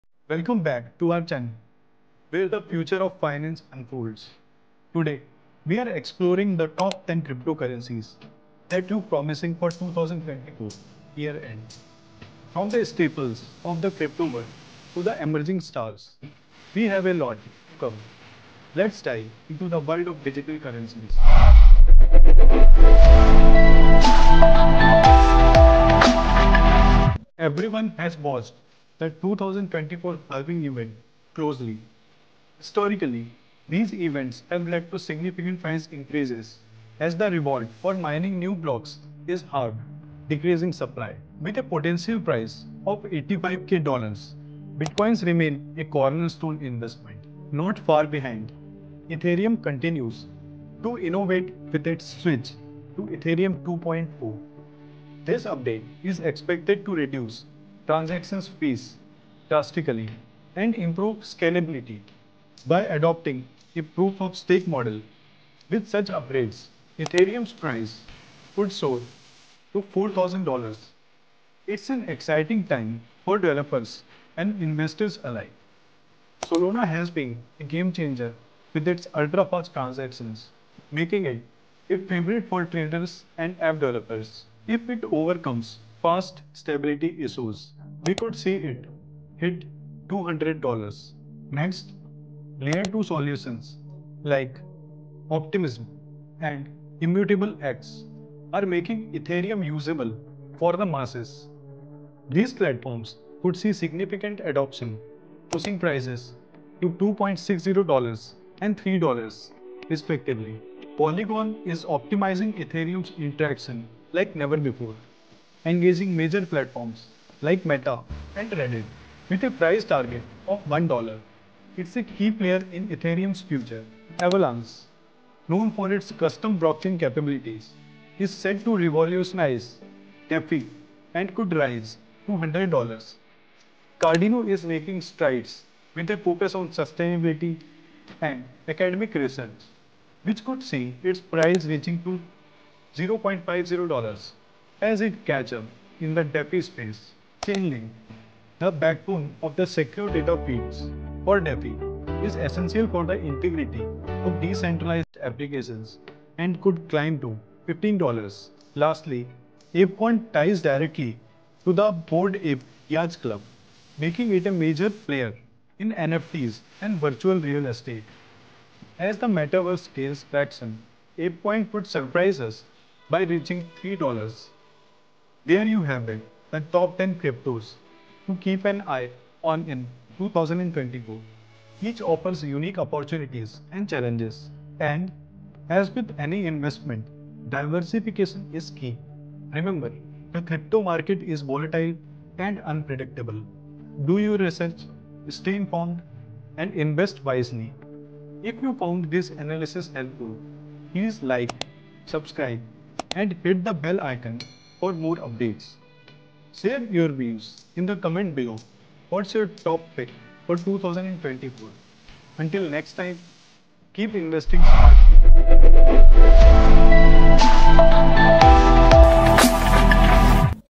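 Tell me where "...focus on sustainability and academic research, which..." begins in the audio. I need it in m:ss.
2:16.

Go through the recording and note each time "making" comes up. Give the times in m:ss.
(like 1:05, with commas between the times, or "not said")
1:21, 1:38, 2:14, 2:43.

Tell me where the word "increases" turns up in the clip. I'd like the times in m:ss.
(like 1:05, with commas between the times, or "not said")
0:35.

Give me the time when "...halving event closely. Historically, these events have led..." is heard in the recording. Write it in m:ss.
0:30.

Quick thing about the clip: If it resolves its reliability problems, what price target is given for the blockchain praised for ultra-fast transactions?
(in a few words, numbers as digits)
$200.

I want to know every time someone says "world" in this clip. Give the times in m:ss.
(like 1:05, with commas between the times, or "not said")
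0:14, 0:19.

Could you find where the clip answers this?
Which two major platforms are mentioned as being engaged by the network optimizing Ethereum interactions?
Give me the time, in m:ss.
1:57.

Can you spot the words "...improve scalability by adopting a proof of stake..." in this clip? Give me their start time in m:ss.
1:00.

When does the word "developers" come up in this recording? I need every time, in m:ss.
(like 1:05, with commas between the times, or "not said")
1:13, 1:23.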